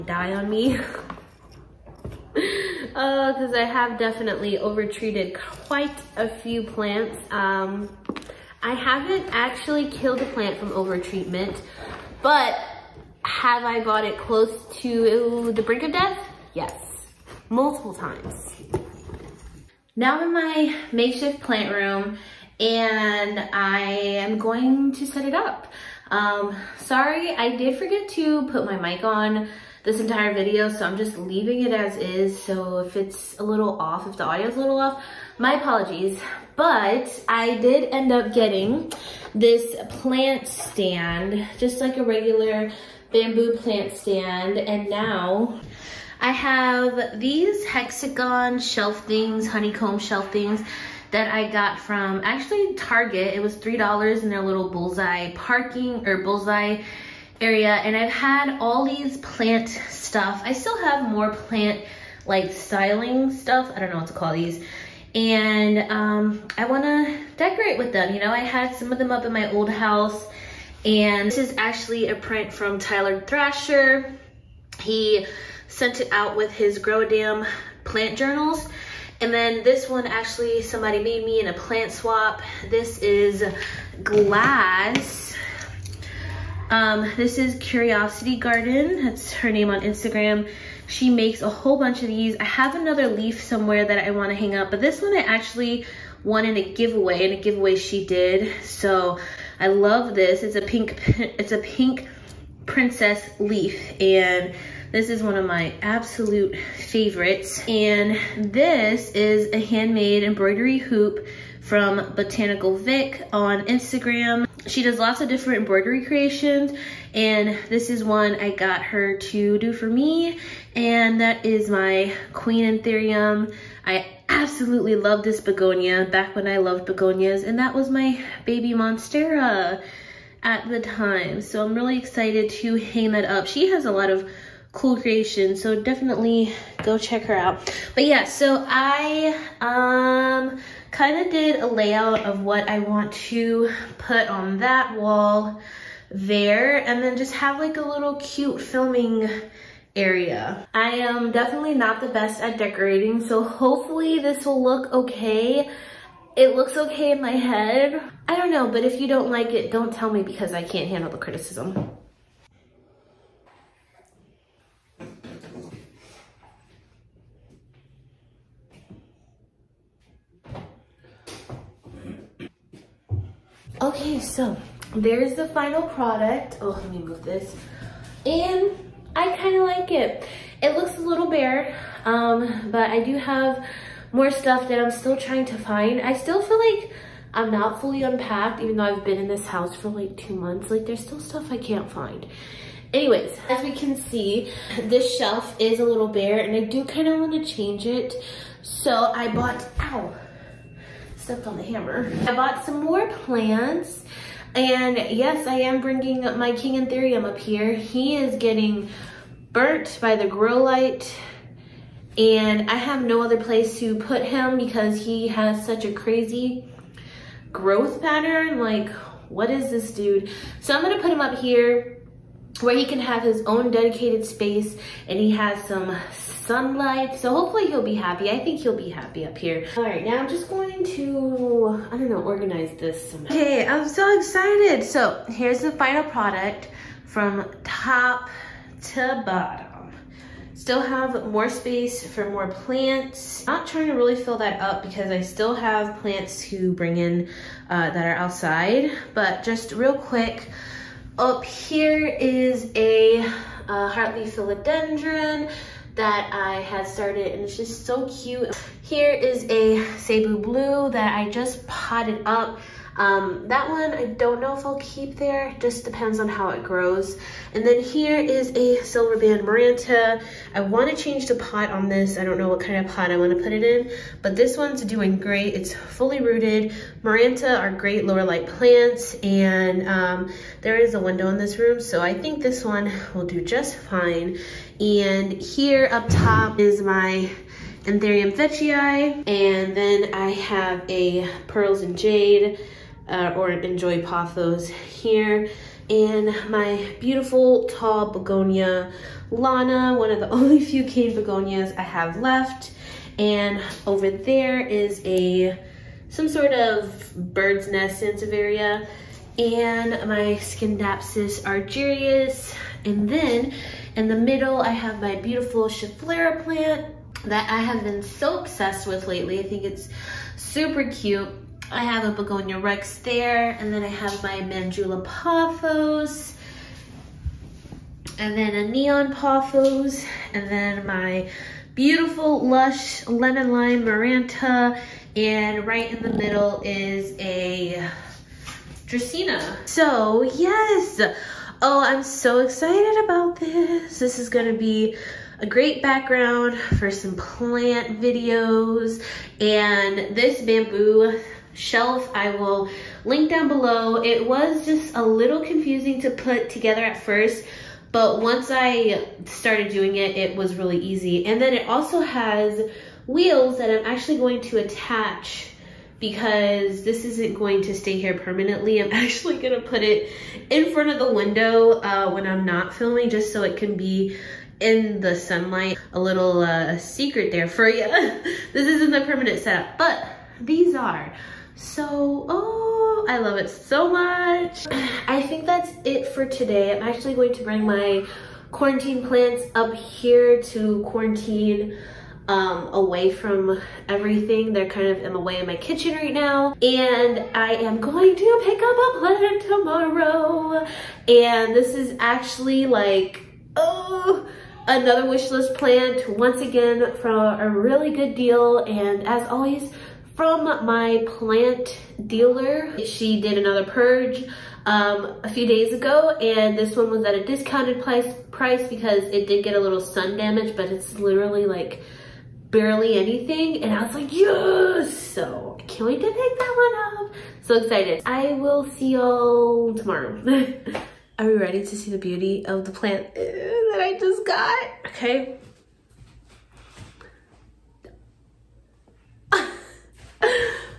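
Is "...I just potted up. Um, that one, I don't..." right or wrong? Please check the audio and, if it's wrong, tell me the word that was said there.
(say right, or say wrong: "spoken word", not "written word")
right.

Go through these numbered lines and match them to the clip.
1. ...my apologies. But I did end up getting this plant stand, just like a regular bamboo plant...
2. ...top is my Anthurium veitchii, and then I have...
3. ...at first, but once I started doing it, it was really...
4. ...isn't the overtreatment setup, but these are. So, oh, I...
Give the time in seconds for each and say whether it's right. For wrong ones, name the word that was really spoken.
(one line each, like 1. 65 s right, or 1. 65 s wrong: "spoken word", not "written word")
1. 35 s right
2. 286 s right
3. 356 s right
4. 378 s wrong: "permanent", not "overtreatment".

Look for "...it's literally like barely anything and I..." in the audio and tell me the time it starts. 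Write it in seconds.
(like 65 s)
420 s.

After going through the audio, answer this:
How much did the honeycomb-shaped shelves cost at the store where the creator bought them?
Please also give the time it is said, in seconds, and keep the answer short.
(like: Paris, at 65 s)
$3, at 53 s.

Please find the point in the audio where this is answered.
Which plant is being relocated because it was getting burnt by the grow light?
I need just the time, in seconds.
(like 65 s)
206 s.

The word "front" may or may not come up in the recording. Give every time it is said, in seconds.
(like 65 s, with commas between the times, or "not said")
370 s.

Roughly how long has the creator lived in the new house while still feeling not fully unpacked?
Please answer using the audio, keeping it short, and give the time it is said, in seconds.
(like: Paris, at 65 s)
2 months, at 190 s.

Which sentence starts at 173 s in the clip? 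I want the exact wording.
Okay, so there's the final product.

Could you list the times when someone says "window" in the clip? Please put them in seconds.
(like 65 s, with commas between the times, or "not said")
280 s, 371 s.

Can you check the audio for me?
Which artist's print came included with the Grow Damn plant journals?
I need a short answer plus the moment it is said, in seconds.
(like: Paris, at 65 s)
Tyler Thrasher, at 72 s.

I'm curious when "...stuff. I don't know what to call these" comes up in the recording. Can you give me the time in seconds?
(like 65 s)
63 s.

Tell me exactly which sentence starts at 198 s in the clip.
So I bought, ow, stepped on the hammer.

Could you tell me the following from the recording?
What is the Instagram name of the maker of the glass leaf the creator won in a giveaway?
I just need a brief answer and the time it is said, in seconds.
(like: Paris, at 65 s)
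Curiosity Garden, at 87 s.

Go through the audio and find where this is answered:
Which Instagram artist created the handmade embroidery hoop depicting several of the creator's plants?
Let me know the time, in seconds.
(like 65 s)
112 s.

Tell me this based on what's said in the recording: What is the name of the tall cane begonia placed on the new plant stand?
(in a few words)
Lana.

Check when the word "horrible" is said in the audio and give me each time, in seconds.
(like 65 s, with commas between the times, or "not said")
not said.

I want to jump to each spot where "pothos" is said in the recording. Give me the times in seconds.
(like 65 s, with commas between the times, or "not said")
294 s, 325 s, 329 s.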